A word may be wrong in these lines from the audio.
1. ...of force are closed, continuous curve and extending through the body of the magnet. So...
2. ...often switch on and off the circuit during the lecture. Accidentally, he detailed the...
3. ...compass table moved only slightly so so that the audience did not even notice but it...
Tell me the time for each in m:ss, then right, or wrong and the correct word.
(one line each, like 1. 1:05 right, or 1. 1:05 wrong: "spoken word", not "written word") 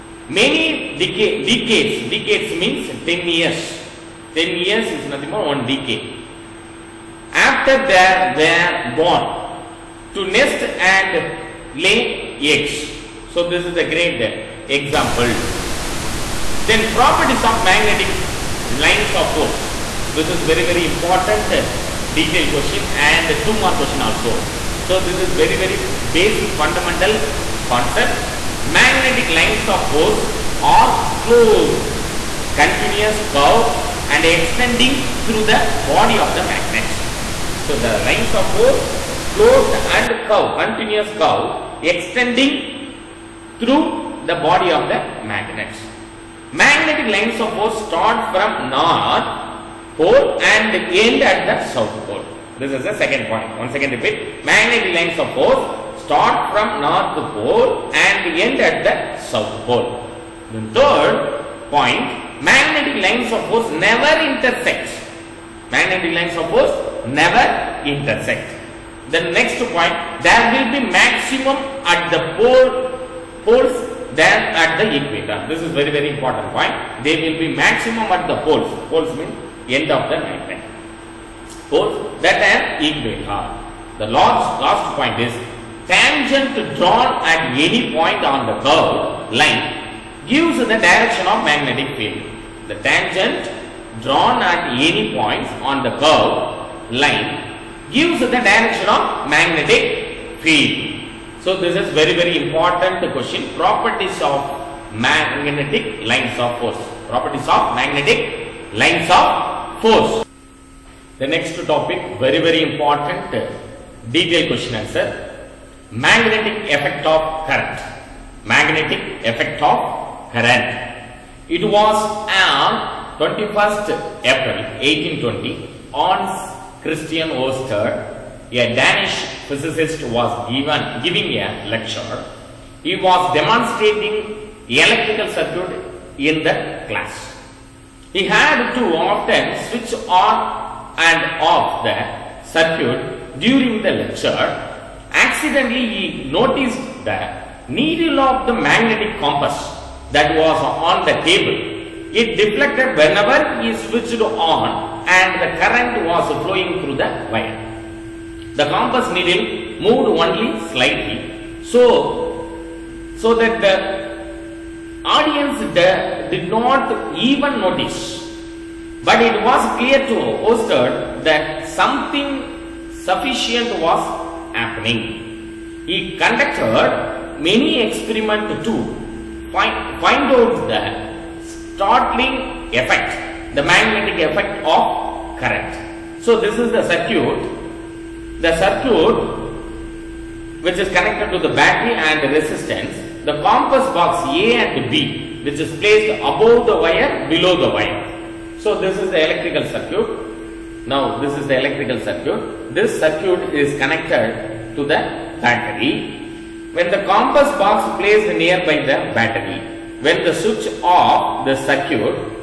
1. 0:29 right
2. 2:18 wrong: "noticed", not "detailed"
3. 2:38 wrong: "needle", not "table".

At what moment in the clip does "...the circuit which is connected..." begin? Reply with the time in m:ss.
3:08.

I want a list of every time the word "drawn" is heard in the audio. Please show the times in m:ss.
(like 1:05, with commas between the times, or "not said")
1:26, 1:34.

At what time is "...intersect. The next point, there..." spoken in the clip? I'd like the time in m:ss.
1:07.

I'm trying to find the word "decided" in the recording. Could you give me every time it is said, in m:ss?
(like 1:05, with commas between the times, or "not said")
not said.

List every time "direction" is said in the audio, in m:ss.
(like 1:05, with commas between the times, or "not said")
1:30, 1:38.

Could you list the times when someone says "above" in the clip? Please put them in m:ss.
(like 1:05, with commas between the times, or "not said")
3:16.